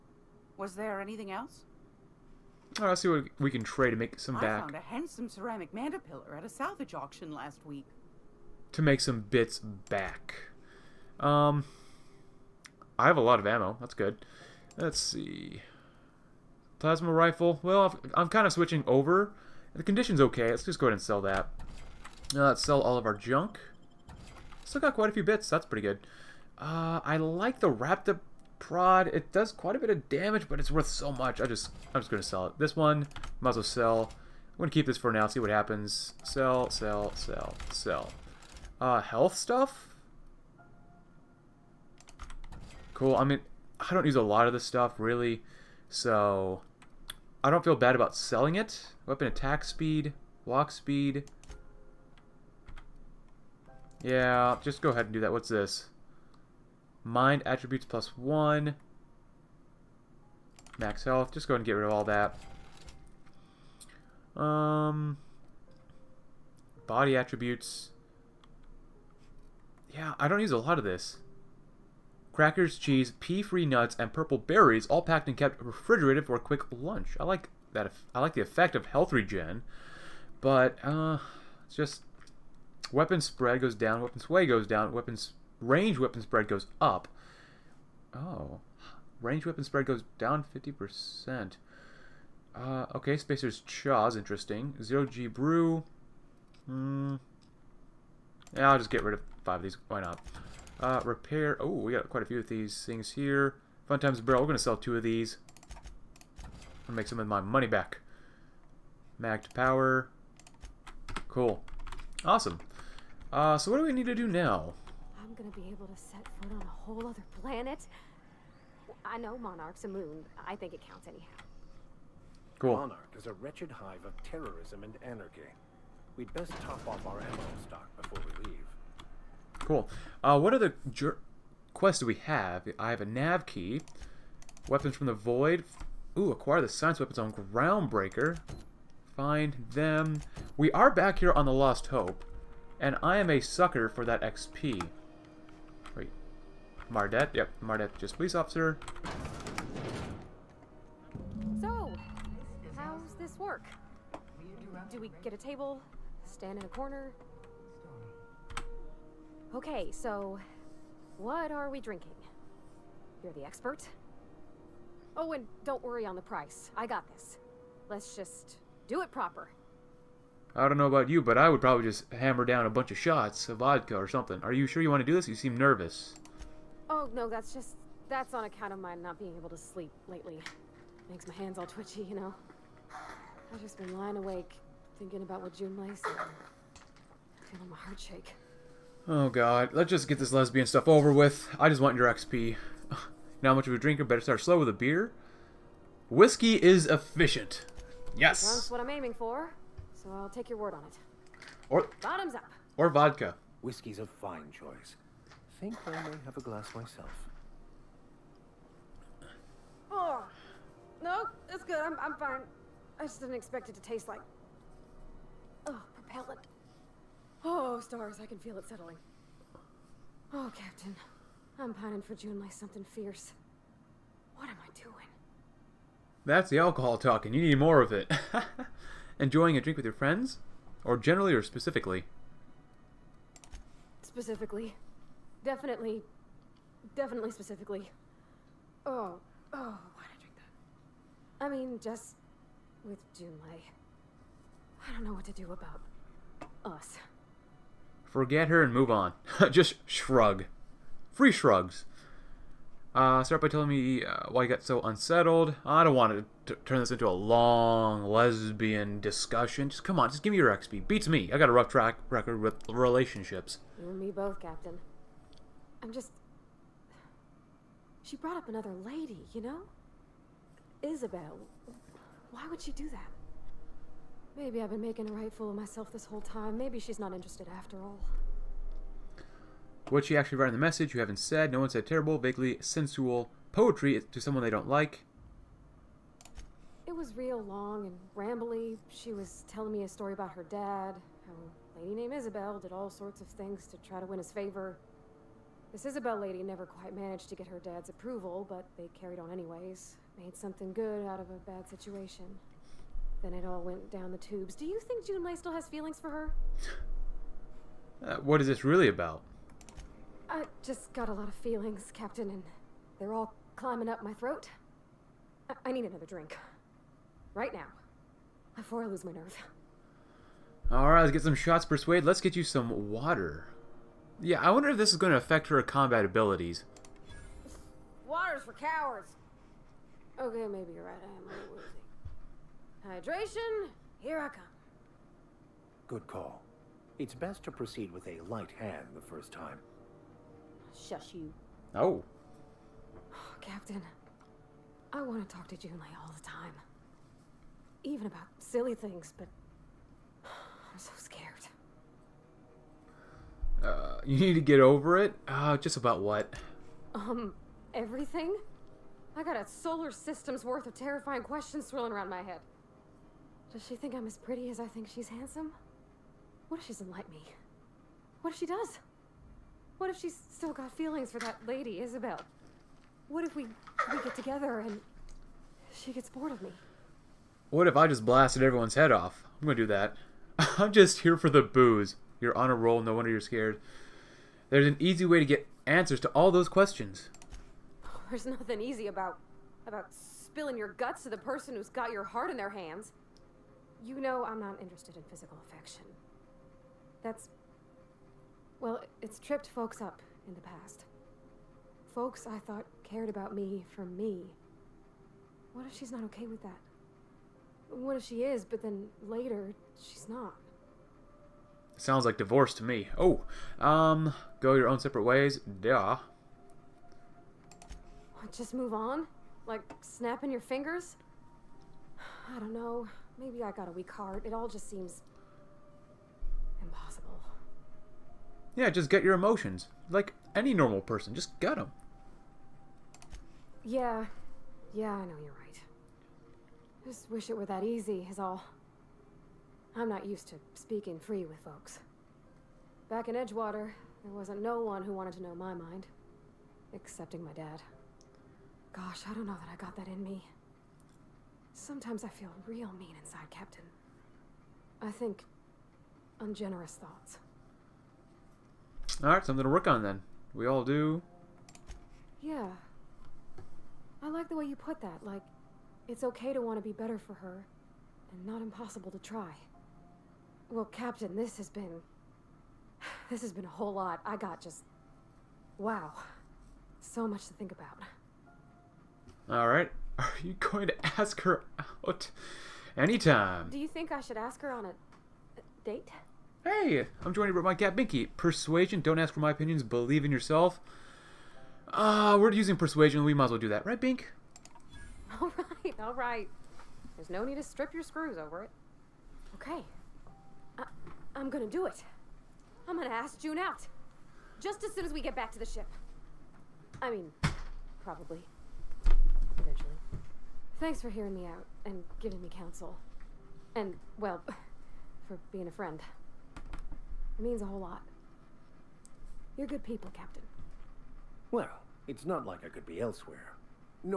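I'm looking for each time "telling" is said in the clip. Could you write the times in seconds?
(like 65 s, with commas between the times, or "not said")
253 s, 289 s.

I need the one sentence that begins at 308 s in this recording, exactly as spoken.
Uh, what is this really about?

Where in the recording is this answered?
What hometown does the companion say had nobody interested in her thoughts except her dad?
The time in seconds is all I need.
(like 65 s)
443 s.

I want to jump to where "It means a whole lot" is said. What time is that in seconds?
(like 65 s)
517 s.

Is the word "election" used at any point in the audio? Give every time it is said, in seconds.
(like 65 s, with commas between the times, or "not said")
not said.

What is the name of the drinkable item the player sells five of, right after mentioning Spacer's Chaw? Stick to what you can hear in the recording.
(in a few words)
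Zero G Brew.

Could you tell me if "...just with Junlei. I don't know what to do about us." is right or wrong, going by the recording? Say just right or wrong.
right.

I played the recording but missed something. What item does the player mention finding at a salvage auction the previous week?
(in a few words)
Ceramic mandapillar.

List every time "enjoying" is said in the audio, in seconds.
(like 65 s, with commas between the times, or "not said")
229 s.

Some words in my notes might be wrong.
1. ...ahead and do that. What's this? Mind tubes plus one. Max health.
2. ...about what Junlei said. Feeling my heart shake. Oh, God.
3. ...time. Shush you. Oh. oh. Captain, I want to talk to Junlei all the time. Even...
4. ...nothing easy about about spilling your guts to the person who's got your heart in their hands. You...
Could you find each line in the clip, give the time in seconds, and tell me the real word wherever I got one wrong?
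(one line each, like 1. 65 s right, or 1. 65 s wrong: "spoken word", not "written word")
1. 54 s wrong: "attributes", not "tubes"
2. 185 s right
3. 339 s right
4. 388 s right.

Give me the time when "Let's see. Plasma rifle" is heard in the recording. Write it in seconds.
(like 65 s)
14 s.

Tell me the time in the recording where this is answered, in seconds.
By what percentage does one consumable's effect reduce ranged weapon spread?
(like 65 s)
90 s.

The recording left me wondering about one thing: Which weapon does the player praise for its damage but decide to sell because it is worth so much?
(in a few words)
Raptor prod.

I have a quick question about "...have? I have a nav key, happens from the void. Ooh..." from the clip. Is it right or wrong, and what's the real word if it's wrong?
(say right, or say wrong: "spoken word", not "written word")
wrong: "weapons", not "happens".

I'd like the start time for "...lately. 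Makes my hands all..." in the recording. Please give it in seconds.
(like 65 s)
180 s.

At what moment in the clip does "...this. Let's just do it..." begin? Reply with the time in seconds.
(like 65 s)
167 s.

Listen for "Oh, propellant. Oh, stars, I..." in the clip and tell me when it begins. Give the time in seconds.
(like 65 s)
215 s.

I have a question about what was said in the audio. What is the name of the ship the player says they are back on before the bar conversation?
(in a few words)
Lost Hope.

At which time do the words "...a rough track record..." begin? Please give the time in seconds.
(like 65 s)
261 s.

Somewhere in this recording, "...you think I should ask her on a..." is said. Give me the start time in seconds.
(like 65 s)
483 s.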